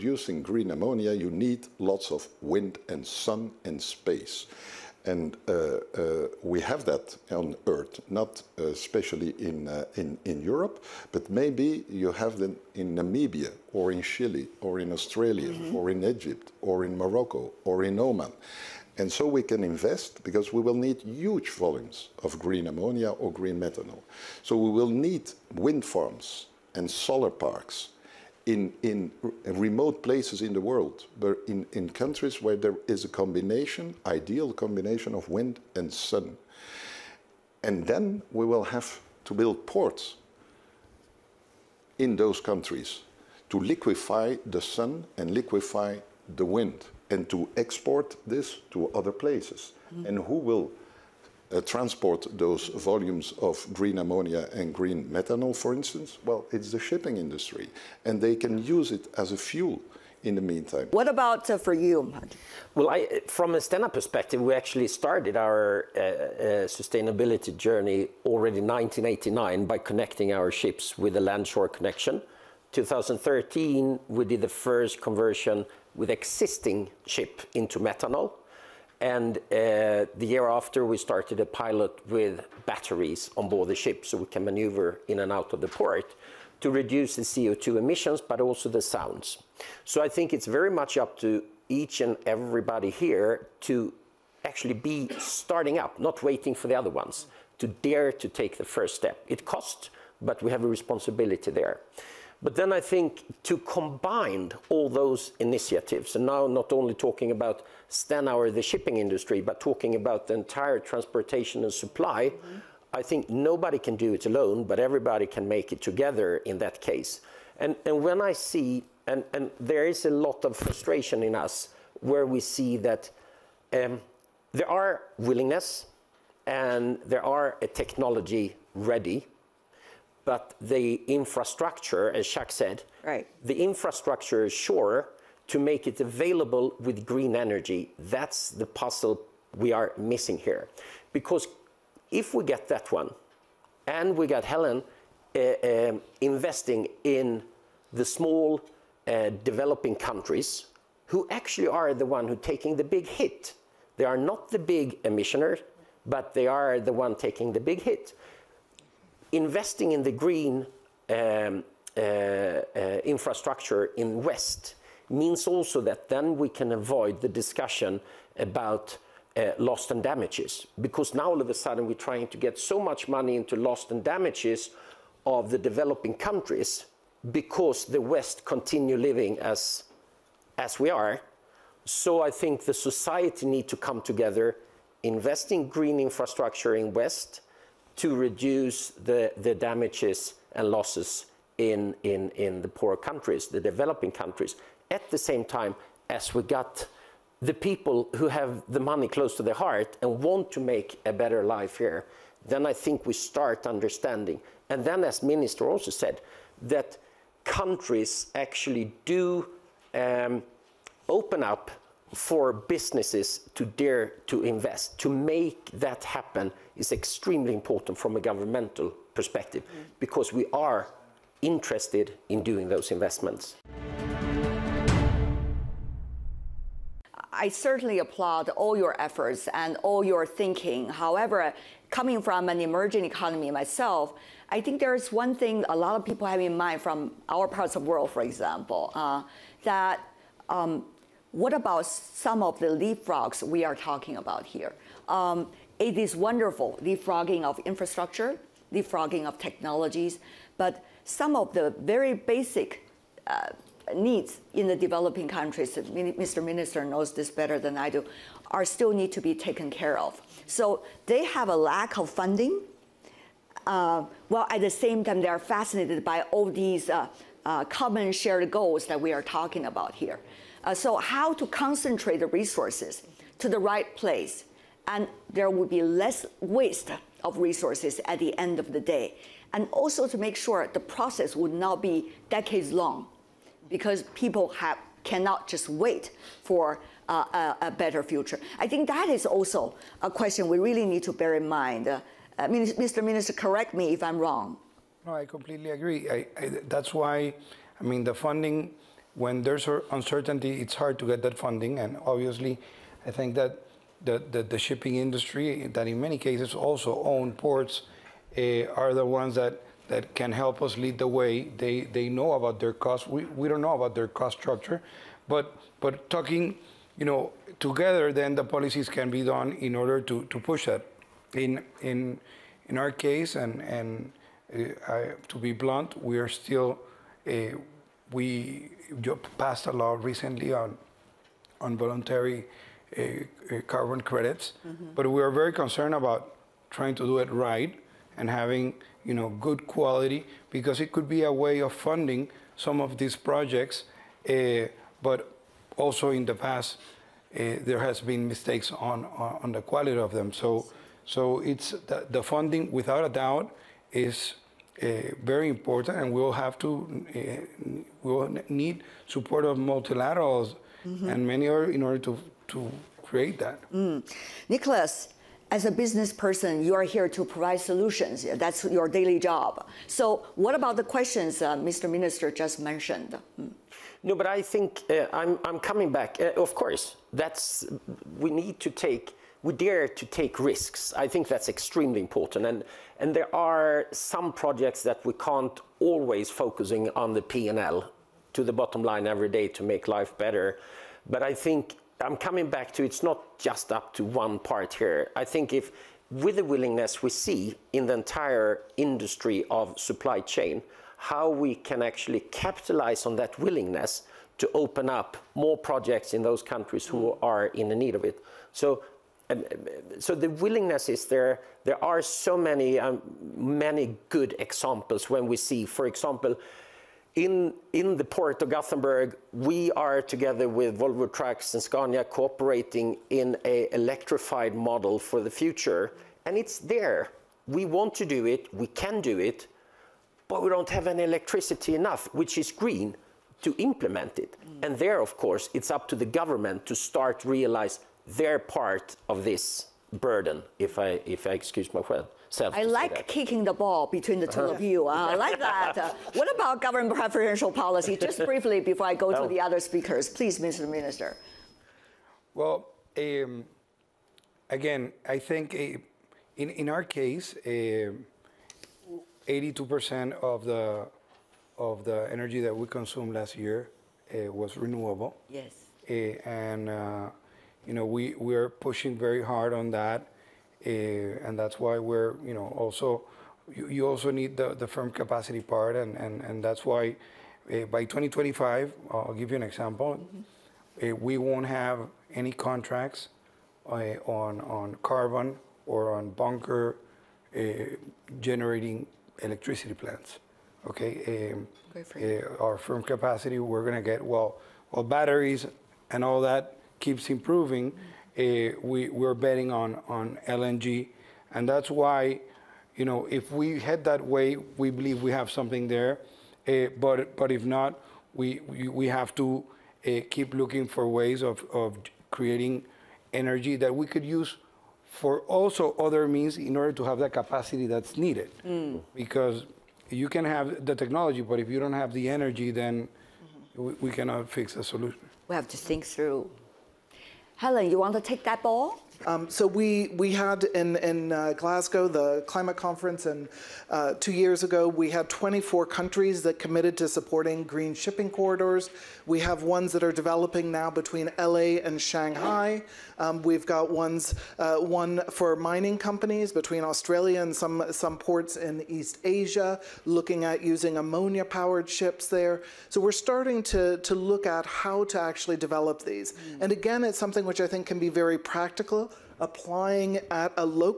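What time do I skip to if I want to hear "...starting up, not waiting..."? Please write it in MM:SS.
01:35.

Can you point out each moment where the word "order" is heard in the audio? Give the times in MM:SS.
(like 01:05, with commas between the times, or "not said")
05:19, 06:01, 08:36.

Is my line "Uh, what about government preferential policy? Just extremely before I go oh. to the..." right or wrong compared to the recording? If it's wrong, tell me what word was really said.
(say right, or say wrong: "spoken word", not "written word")
wrong: "briefly", not "extremely".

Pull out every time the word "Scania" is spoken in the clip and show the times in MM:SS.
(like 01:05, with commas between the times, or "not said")
07:01.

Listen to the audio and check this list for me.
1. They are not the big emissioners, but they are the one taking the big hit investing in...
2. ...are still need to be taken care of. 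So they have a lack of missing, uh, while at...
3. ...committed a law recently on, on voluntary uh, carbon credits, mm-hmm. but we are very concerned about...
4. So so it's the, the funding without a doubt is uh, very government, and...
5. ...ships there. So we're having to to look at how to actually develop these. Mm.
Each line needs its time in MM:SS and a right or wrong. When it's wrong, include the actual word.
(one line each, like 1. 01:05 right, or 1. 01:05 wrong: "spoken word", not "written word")
1. 02:33 right
2. 04:18 wrong: "funding", not "missing"
3. 05:29 wrong: "passed", not "committed"
4. 05:50 wrong: "important", not "government"
5. 09:11 wrong: "starting", not "having".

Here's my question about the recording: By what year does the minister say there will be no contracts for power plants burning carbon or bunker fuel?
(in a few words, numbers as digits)
2025.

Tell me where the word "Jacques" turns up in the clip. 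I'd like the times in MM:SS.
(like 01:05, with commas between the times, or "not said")
02:12.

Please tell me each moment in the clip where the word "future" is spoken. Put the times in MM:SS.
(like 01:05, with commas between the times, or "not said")
04:48, 07:05.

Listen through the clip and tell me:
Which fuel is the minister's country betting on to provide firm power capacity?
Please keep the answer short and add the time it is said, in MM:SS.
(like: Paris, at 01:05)
LNG, at 08:20.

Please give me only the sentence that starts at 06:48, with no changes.
So so the willingness is there.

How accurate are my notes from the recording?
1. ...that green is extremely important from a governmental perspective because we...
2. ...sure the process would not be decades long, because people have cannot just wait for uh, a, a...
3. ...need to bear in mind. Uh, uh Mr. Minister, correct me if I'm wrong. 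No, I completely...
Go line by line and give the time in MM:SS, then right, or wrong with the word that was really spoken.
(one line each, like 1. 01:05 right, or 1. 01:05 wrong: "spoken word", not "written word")
1. 03:35 wrong: "happen", not "green"
2. 04:40 right
3. 04:50 right.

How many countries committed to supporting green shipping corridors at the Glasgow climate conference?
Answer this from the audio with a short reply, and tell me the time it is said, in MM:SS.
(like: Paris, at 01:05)
24, at 08:55.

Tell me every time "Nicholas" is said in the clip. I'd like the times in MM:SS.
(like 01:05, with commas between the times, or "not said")
06:04.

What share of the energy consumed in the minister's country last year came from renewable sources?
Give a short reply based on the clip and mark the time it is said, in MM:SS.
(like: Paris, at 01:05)
82%, at 07:37.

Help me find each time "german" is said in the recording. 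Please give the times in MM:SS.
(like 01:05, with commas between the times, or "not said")
not said.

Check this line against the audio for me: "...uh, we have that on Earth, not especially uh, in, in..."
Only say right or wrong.
right.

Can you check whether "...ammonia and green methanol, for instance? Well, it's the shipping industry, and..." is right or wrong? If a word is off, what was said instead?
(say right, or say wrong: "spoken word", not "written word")
right.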